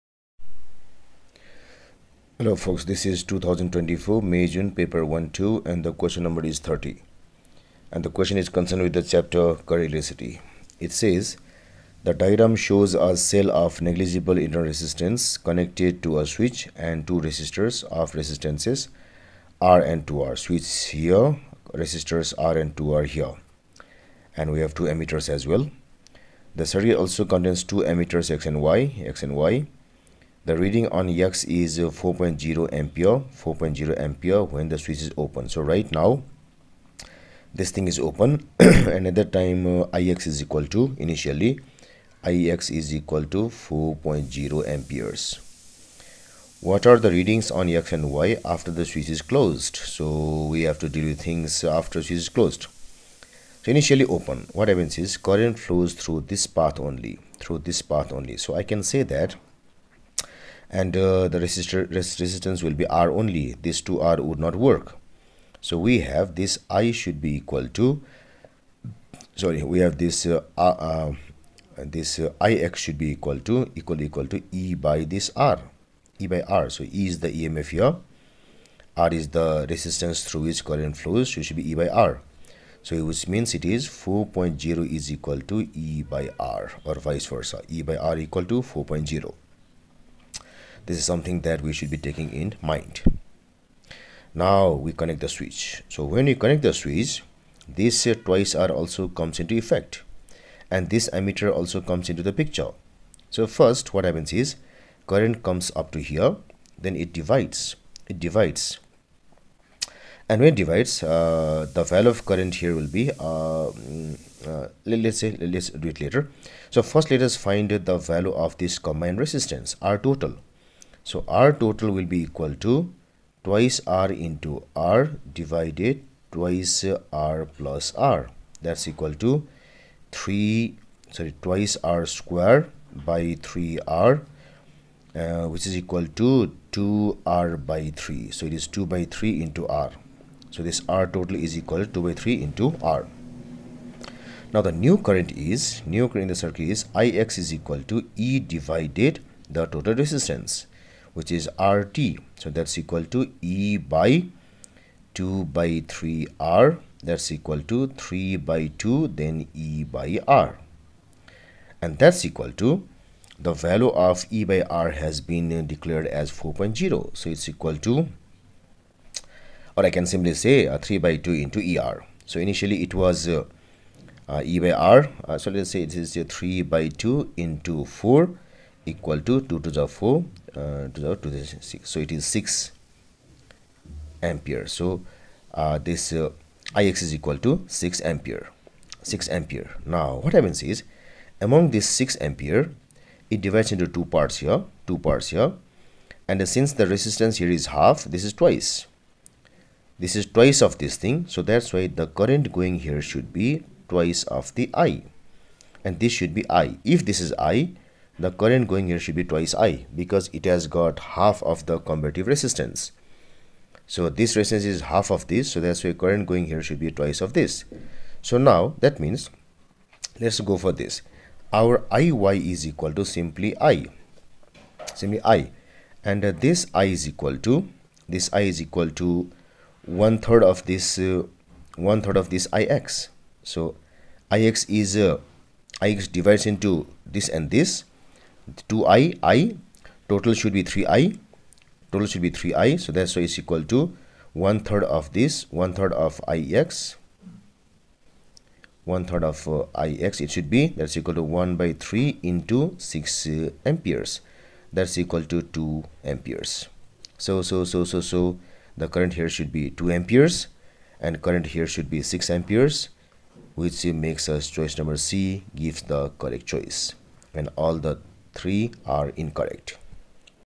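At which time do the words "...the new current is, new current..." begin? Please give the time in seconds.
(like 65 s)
144 s.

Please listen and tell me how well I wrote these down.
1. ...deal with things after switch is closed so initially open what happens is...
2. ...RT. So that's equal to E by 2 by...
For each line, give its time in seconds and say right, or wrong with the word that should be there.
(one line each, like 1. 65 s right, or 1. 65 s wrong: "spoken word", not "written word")
1. 50 s right
2. 151 s right.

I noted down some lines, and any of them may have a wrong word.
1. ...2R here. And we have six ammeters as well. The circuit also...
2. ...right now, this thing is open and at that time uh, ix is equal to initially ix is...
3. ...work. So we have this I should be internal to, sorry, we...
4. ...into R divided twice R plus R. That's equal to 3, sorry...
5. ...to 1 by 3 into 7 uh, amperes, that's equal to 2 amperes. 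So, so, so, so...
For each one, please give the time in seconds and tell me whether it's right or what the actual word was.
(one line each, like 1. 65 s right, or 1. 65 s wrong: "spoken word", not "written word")
1. 22 s wrong: "two", not "six"
2. 35 s right
3. 64 s wrong: "equal", not "internal"
4. 124 s right
5. 251 s wrong: "6", not "7".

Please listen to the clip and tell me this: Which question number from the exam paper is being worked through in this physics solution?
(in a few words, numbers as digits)
30.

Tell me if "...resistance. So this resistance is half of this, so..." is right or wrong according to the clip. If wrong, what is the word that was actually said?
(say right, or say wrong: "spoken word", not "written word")
right.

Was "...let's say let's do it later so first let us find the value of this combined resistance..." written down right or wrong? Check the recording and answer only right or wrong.
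right.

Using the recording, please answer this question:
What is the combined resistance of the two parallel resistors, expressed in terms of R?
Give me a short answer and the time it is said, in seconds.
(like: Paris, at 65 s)
2R/3, at 136 s.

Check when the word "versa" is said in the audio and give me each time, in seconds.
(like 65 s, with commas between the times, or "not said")
87 s.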